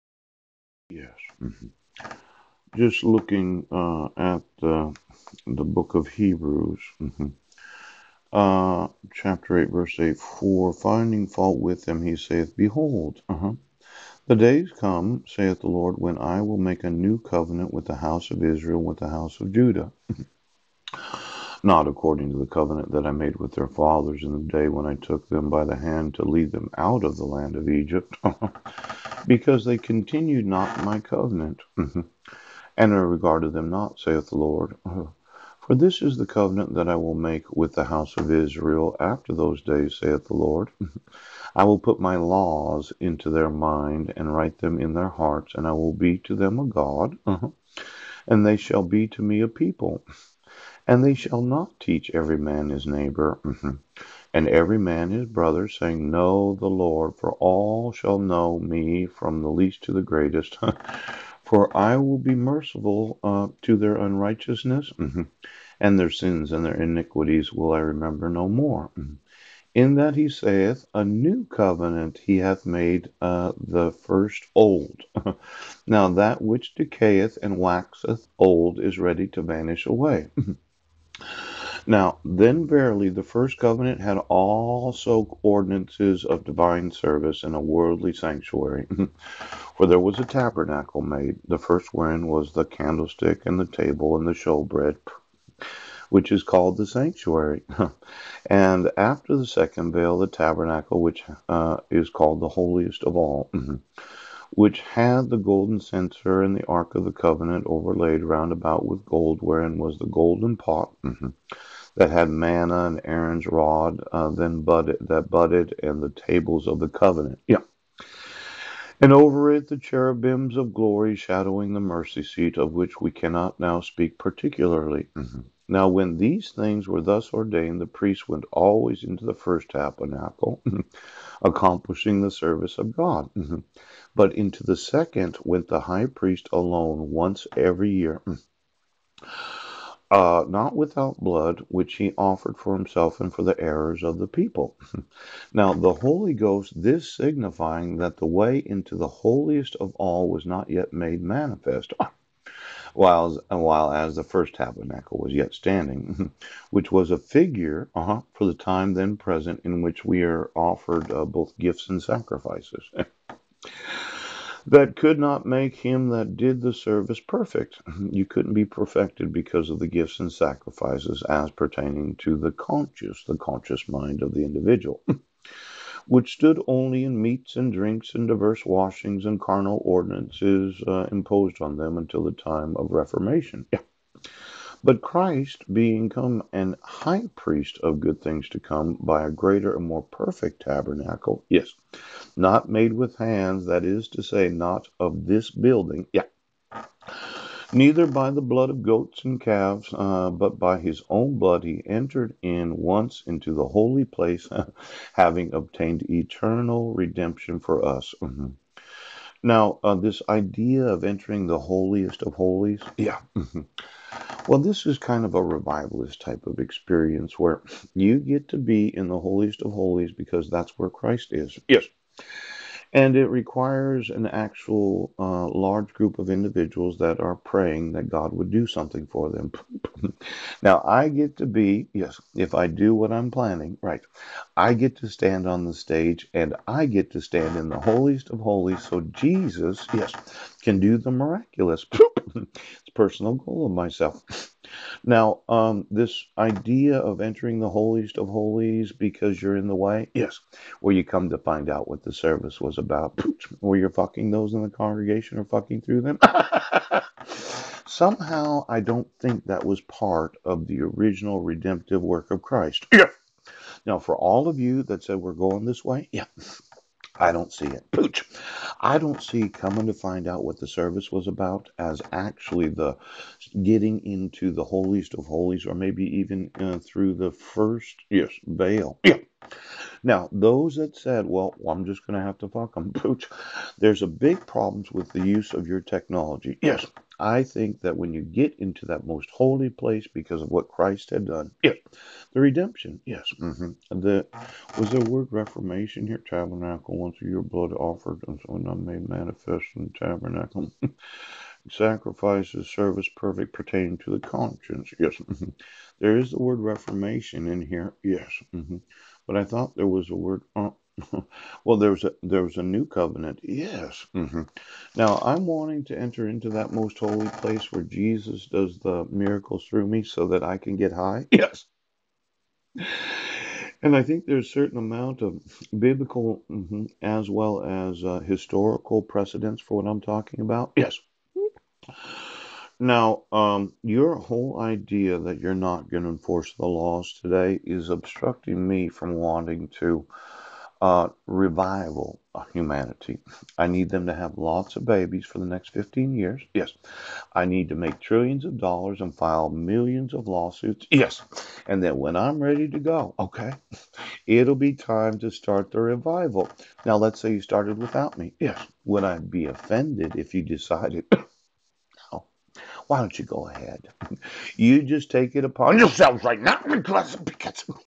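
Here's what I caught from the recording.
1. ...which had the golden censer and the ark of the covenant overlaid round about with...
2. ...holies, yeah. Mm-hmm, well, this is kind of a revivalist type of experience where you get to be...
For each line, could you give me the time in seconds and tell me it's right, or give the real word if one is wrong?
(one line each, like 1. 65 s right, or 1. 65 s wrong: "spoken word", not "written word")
1. 104 s right
2. 212 s right.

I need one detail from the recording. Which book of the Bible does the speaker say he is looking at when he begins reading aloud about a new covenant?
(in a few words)
Hebrews.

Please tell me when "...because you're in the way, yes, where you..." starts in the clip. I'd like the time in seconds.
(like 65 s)
248 s.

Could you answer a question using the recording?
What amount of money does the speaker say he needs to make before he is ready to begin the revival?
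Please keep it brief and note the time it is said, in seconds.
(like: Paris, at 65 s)
trillions of dollars, at 347 s.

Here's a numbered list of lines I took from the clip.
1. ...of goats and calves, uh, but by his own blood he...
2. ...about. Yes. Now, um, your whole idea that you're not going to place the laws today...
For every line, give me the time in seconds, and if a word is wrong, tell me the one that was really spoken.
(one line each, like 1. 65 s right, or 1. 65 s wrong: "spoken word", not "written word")
1. 198 s right
2. 330 s wrong: "enforce", not "place".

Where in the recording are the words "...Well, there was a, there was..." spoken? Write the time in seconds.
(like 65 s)
311 s.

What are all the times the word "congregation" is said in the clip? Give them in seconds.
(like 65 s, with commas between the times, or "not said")
254 s.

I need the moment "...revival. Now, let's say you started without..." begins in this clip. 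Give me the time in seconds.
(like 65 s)
355 s.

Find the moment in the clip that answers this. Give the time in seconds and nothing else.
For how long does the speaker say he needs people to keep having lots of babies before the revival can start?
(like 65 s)
345 s.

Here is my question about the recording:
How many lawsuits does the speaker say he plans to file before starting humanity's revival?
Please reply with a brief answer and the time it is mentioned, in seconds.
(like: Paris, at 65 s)
millions, at 349 s.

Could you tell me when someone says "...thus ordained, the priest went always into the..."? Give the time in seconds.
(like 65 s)
127 s.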